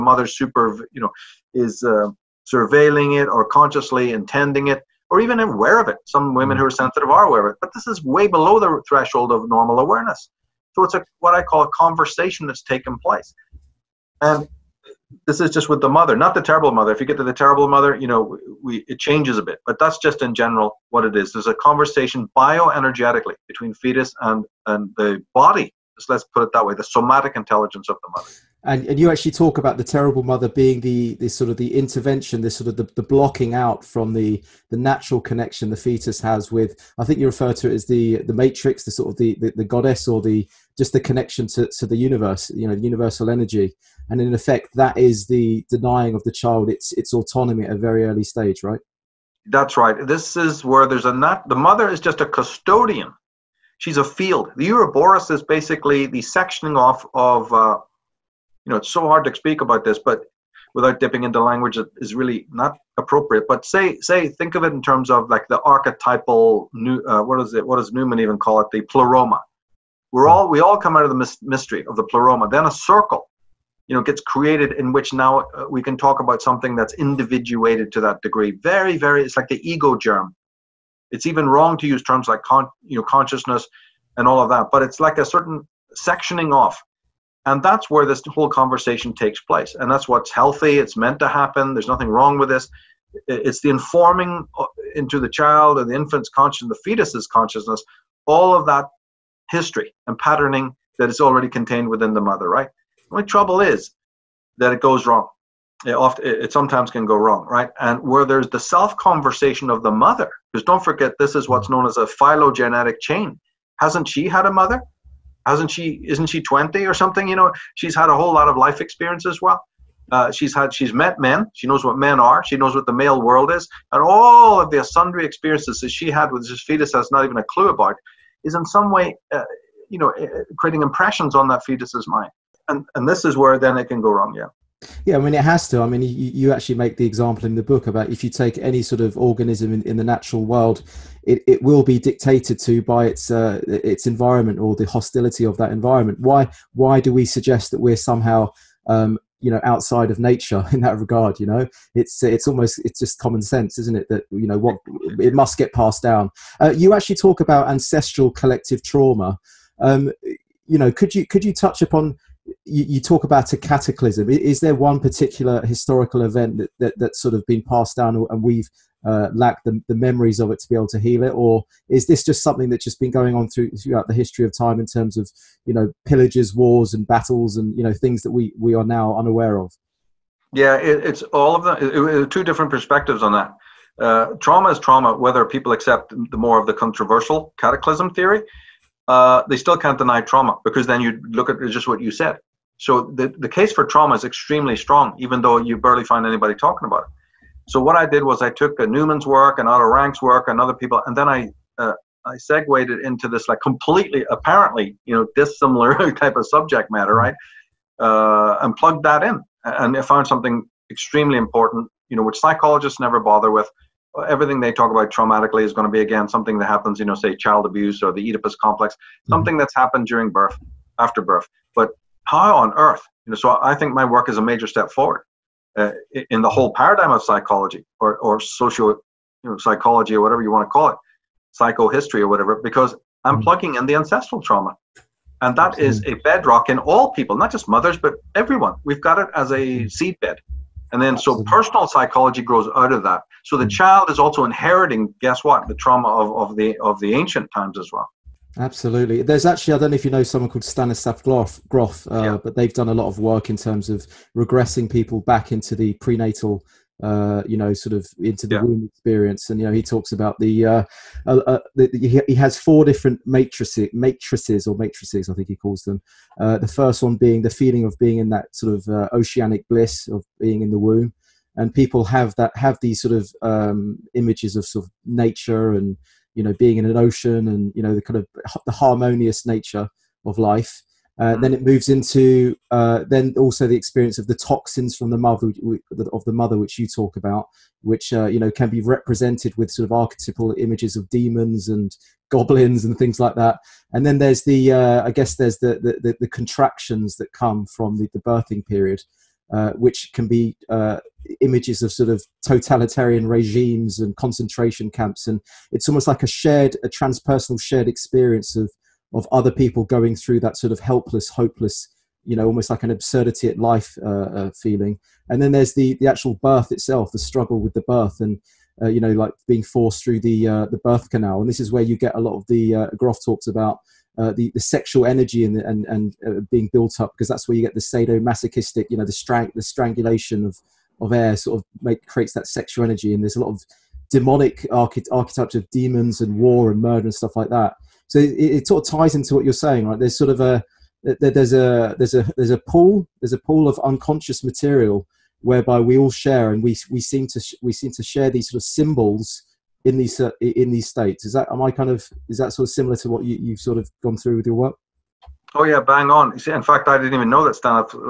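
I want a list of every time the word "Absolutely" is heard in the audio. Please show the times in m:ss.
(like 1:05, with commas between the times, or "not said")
3:55, 4:08.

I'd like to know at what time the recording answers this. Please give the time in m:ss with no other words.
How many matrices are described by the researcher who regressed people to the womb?
4:22.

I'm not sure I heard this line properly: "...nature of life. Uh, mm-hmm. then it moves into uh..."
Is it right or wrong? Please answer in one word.
right.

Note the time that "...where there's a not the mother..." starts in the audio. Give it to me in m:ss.
0:50.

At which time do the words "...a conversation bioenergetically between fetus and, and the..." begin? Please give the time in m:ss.
0:21.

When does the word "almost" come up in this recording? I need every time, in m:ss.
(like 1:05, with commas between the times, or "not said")
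2:32, 5:05, 5:12.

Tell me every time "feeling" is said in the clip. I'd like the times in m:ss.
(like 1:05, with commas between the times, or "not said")
4:27, 5:14.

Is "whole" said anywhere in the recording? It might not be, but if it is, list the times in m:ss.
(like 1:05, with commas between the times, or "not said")
1:28, 1:58, 3:46.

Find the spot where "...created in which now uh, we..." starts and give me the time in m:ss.
1:14.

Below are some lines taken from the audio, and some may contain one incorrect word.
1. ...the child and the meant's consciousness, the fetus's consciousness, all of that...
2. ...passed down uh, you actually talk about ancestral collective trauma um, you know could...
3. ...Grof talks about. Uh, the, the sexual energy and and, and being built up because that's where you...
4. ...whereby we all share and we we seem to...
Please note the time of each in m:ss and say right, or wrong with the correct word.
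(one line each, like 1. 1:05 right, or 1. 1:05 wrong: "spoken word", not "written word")
1. 1:35 wrong: "infant", not "meant"
2. 2:35 right
3. 5:22 right
4. 5:45 right.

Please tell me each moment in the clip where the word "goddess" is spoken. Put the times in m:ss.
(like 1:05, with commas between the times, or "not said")
0:39.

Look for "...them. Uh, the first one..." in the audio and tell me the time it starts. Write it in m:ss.
4:25.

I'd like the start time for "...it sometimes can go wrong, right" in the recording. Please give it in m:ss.
1:46.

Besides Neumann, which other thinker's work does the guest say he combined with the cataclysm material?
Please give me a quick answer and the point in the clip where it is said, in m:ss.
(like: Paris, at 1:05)
Otto Rank, at 3:19.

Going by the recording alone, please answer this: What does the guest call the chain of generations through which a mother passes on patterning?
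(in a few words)
phylogenetic chain.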